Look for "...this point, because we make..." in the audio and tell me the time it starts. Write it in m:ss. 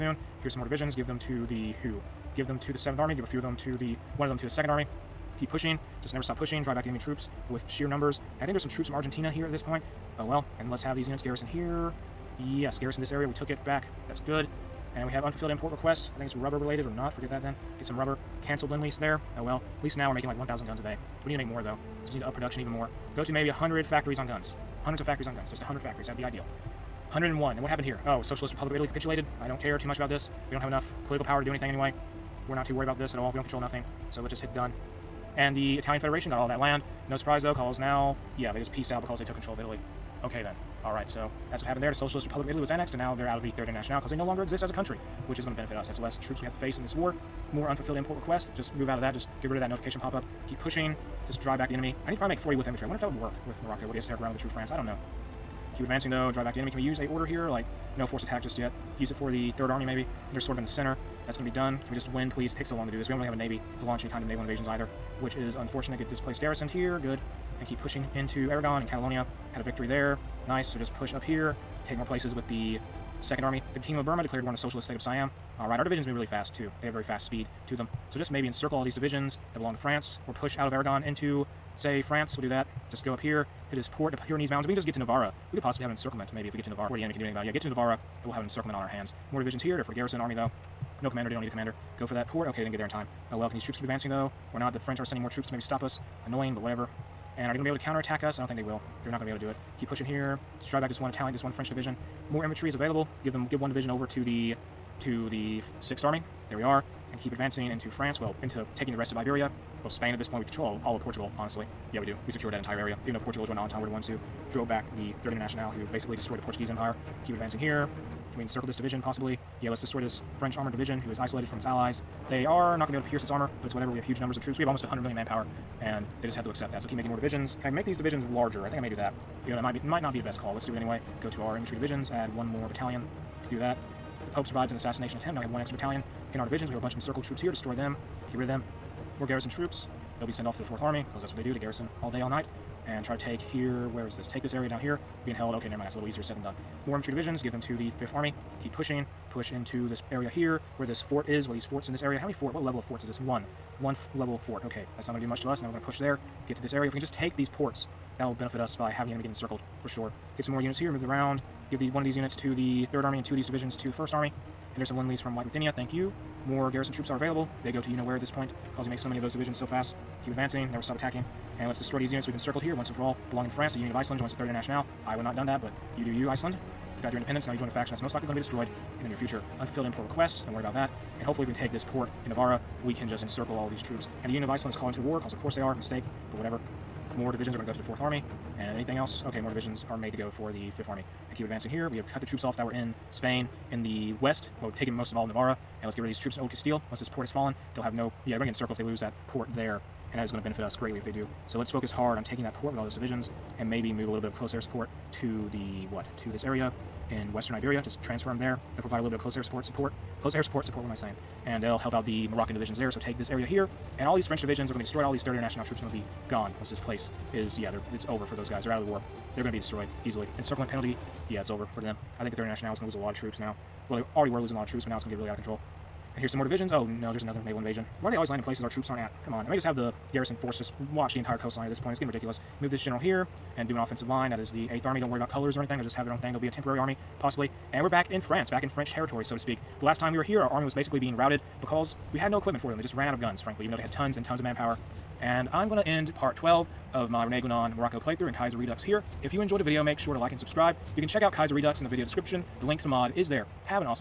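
2:48.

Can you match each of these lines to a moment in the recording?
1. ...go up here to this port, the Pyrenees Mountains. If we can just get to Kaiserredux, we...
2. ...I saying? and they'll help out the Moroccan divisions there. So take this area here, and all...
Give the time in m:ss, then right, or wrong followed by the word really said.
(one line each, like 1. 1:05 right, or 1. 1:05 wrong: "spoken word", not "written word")
1. 1:23 wrong: "Navarra", not "Kaiserredux"
2. 3:30 right.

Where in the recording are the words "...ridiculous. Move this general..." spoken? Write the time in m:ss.
3:52.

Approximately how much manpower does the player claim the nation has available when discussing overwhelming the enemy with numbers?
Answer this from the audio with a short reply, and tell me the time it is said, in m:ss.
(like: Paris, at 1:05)
almost 100 million, at 2:04.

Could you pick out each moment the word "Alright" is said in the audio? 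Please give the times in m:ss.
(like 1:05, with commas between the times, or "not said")
0:40, 1:15.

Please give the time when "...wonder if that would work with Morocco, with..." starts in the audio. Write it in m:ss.
0:52.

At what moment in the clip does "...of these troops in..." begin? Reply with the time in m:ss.
3:16.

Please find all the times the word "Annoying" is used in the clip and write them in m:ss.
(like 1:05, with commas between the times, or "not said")
1:36.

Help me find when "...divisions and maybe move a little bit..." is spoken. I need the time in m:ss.
3:22.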